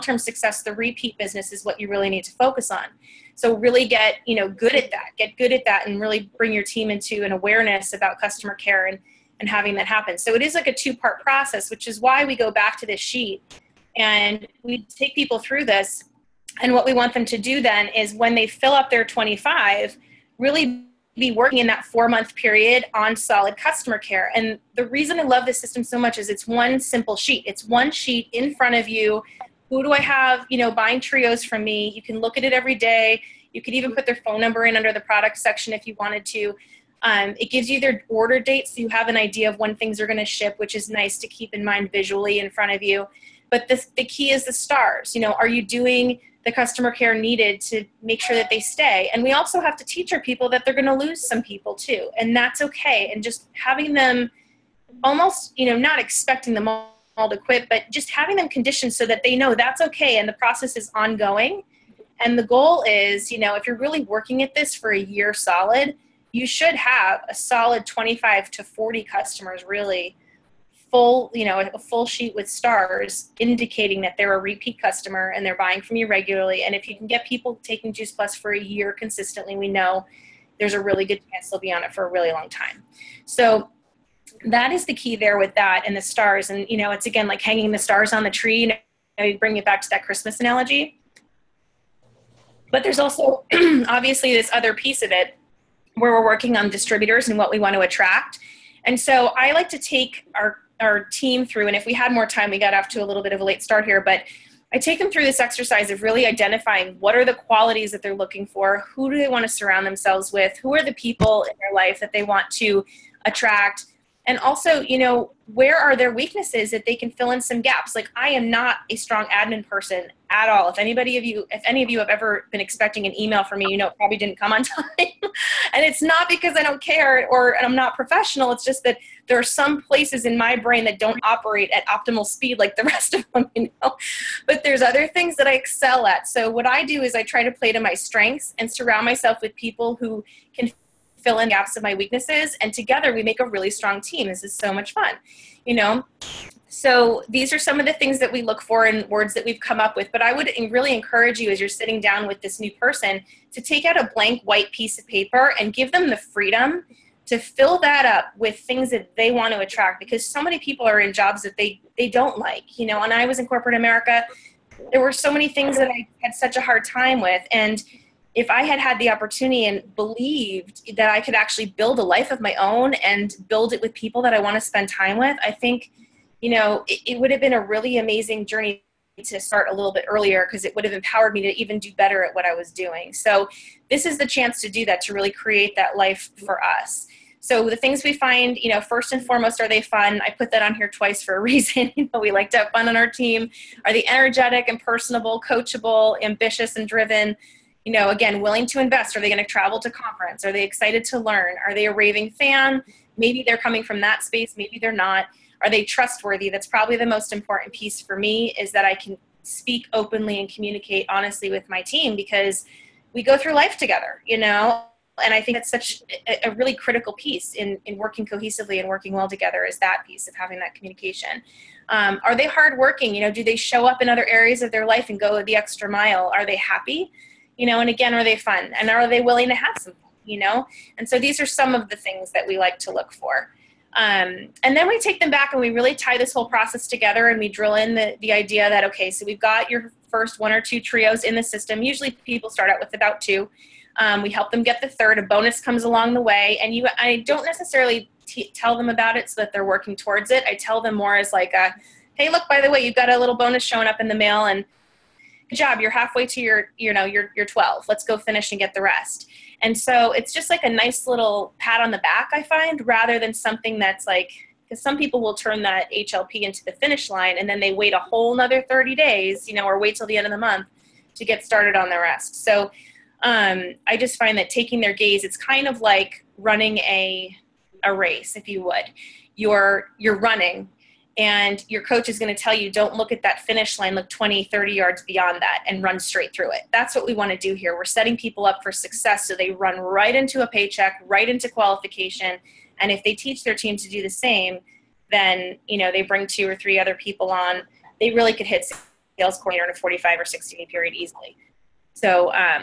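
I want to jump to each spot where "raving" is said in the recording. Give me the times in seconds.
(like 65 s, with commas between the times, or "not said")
201 s.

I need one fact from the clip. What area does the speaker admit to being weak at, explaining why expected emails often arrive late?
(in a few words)
admin.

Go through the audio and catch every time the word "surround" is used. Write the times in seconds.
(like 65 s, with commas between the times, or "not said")
109 s, 138 s.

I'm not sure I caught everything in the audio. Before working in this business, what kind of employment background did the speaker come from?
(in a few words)
corporate America.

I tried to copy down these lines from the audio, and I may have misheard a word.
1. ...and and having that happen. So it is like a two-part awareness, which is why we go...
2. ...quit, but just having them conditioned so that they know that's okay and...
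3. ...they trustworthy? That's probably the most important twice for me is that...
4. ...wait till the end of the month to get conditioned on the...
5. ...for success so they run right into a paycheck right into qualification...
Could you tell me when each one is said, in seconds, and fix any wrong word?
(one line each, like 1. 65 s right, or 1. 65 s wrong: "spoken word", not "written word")
1. 8 s wrong: "process", not "awareness"
2. 57 s right
3. 205 s wrong: "piece", not "twice"
4. 269 s wrong: "started", not "conditioned"
5. 288 s right.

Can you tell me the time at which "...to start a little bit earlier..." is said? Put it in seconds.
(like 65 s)
179 s.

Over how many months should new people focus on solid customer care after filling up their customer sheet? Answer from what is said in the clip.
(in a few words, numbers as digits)
4.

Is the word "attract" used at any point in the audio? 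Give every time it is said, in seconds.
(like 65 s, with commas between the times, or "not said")
97 s, 113 s, 159 s.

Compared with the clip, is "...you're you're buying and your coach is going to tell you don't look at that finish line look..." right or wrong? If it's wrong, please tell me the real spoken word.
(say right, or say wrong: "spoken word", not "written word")
wrong: "running", not "buying".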